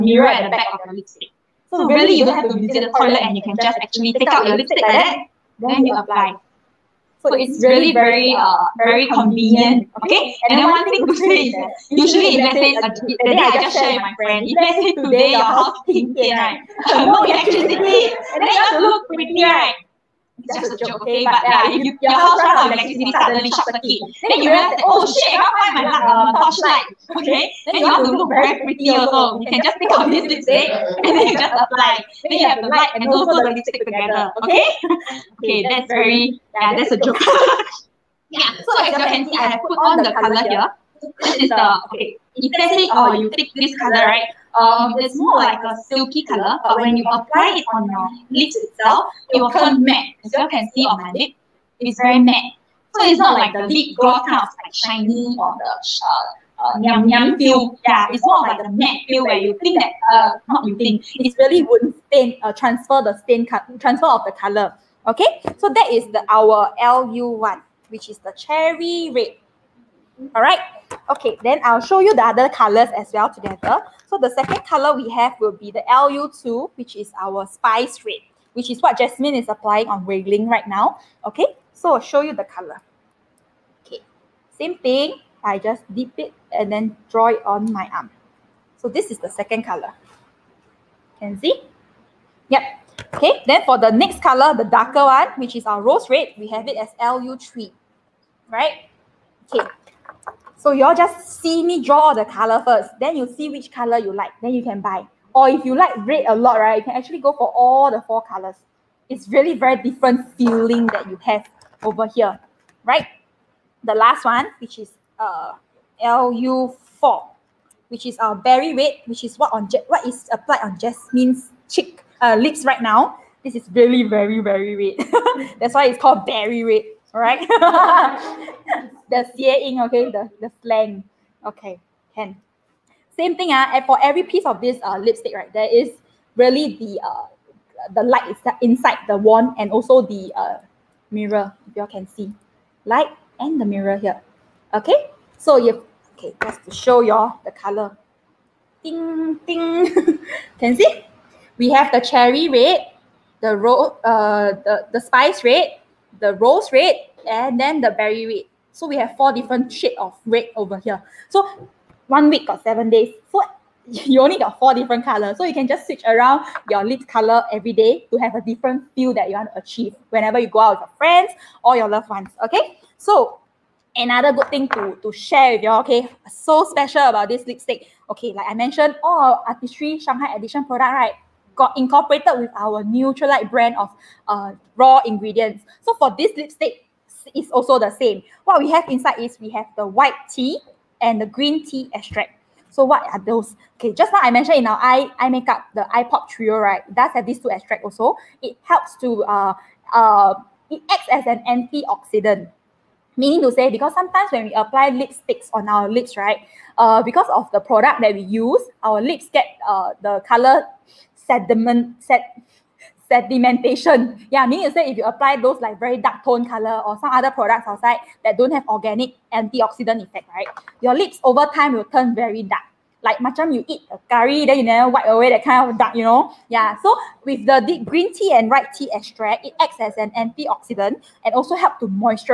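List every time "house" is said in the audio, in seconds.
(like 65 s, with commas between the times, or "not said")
15 s, 22 s.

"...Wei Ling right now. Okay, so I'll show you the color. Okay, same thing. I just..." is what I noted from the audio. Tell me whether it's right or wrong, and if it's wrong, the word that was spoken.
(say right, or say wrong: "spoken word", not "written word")
right.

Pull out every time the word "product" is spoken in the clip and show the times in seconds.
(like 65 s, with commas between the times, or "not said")
180 s, 207 s, 217 s.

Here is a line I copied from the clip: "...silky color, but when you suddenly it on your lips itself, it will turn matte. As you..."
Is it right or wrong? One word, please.
wrong.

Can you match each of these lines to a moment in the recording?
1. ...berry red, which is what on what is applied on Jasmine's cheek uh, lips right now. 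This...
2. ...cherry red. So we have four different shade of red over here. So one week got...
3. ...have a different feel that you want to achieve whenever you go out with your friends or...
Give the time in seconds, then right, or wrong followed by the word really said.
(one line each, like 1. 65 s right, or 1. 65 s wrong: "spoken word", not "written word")
1. 118 s right
2. 157 s wrong: "berry", not "cherry"
3. 168 s right.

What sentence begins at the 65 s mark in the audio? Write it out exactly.
Okay, so that is the our LU one, which is the cherry red.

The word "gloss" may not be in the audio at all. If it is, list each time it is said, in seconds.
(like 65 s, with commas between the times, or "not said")
53 s.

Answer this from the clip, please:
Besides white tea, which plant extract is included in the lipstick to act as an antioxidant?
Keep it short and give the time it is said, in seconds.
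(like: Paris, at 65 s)
Green tea extract, at 191 s.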